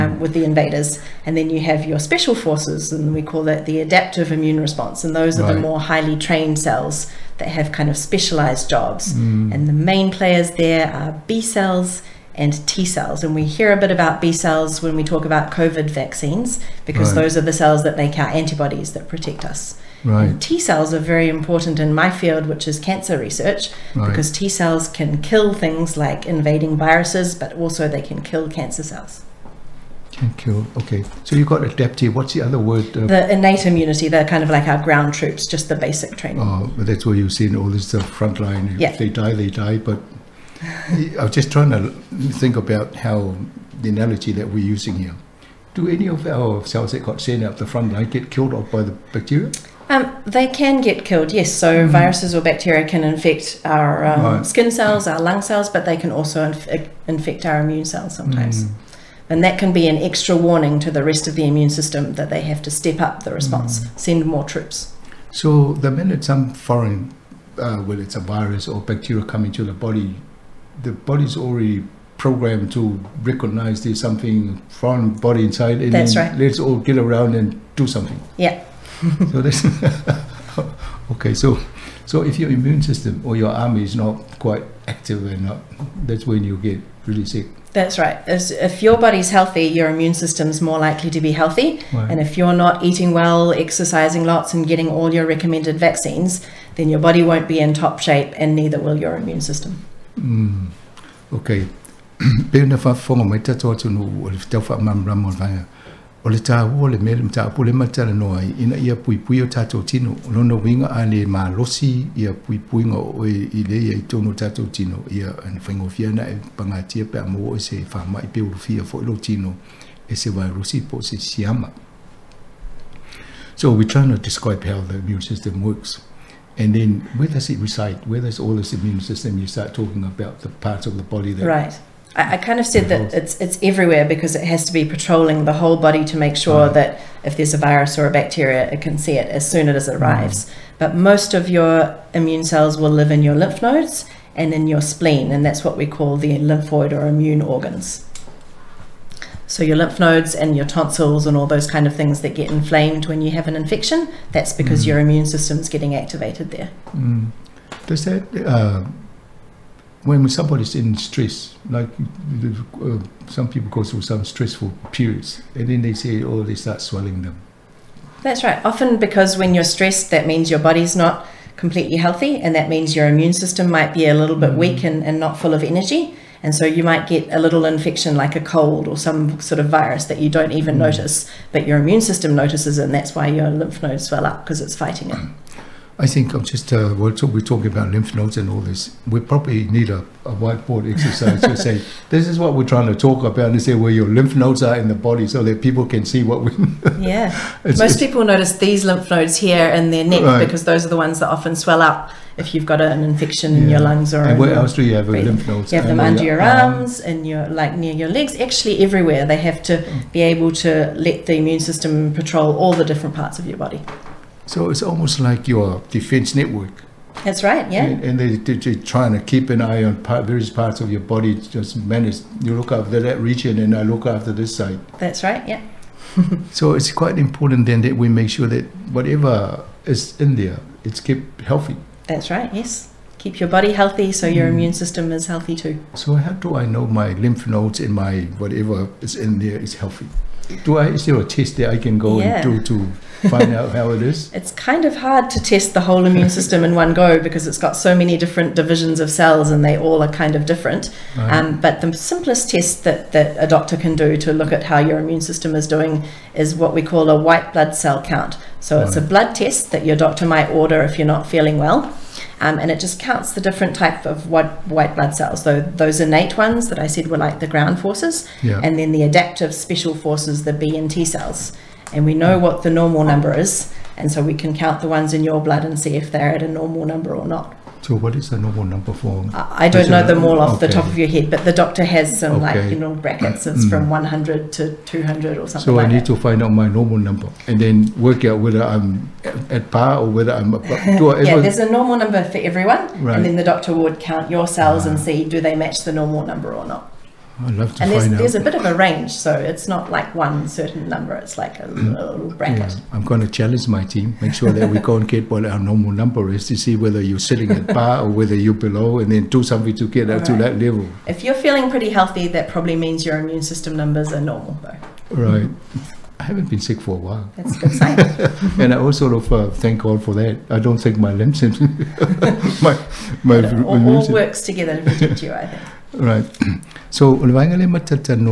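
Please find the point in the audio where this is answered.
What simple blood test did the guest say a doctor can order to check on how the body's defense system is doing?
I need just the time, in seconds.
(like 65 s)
257 s.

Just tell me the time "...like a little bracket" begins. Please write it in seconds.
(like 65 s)
301 s.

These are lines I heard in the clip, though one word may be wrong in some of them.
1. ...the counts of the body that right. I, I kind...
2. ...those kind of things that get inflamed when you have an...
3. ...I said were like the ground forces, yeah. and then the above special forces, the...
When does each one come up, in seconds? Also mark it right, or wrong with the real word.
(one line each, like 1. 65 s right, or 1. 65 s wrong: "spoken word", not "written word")
1. 130 s wrong: "parts", not "counts"
2. 151 s right
3. 266 s wrong: "adaptive", not "above".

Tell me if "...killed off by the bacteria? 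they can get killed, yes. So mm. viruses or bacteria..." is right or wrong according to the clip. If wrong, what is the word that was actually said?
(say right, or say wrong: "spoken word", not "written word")
right.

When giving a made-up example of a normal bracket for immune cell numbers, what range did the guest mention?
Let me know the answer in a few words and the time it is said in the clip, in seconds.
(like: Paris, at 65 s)
100 to 200, at 283 s.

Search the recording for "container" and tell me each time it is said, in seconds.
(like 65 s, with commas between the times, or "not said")
not said.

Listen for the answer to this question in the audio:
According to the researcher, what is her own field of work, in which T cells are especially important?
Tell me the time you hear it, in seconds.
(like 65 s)
22 s.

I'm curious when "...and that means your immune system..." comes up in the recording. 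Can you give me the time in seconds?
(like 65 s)
172 s.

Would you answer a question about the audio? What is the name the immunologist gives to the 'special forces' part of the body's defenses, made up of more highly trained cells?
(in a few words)
adaptive immune response.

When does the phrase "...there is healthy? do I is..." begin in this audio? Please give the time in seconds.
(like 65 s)
239 s.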